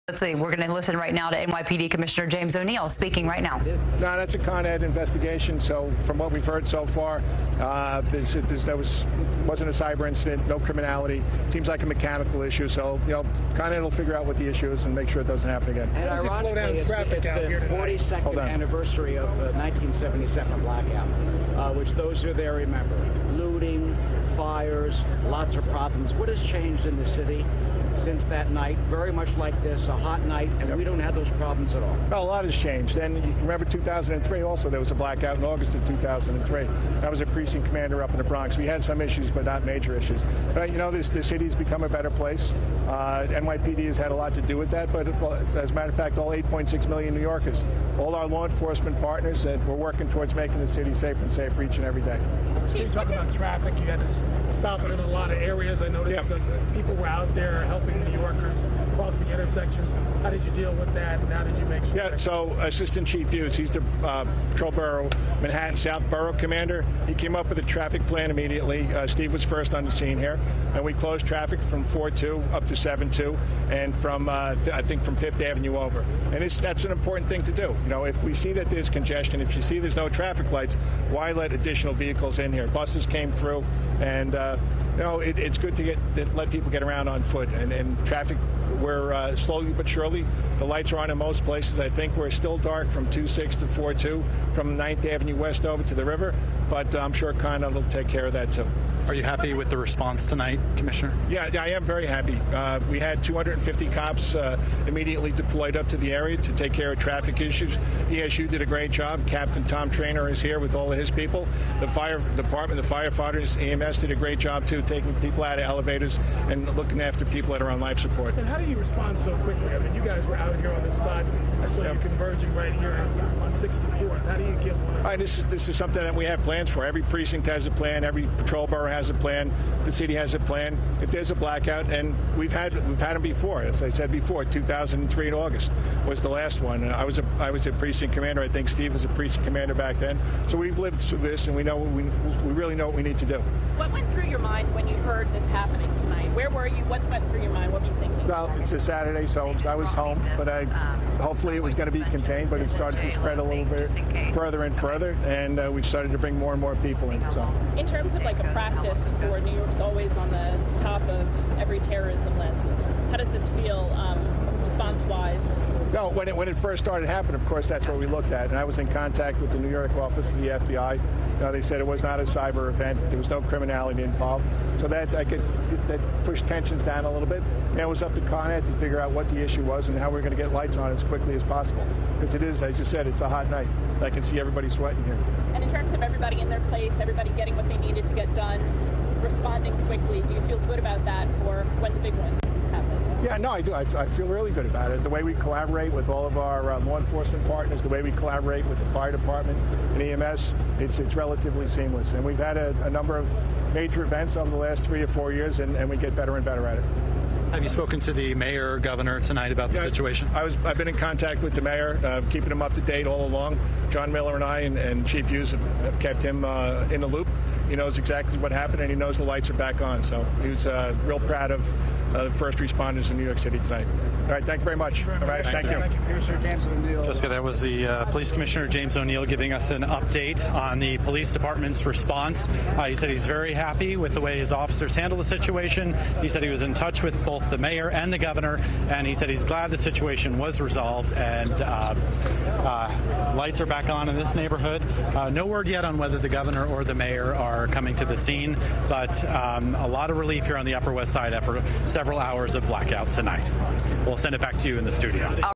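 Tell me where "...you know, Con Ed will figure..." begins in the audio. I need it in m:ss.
0:13.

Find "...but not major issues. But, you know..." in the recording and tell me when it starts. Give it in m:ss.
0:39.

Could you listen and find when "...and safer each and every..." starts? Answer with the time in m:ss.
0:51.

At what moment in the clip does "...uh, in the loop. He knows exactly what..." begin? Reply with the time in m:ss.
3:36.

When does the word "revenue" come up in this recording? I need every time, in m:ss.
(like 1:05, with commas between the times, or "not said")
not said.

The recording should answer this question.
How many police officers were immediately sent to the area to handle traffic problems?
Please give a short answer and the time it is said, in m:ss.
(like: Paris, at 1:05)
250, at 1:43.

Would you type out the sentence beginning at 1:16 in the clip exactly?
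And that's an important thing to do.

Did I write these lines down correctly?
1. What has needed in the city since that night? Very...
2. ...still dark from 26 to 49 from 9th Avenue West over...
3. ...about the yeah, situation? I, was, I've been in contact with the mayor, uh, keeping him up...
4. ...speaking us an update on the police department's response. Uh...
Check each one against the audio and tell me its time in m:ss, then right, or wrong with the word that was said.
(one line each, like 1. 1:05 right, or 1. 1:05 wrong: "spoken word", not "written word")
1. 0:26 wrong: "changed", not "needed"
2. 1:32 wrong: "42", not "49"
3. 3:29 right
4. 3:49 wrong: "giving", not "speaking".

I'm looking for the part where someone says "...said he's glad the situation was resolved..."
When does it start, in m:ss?
3:59.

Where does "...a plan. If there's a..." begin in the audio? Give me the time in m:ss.
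2:10.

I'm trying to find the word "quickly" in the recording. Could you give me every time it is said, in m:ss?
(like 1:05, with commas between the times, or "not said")
1:59, 3:01, 3:09.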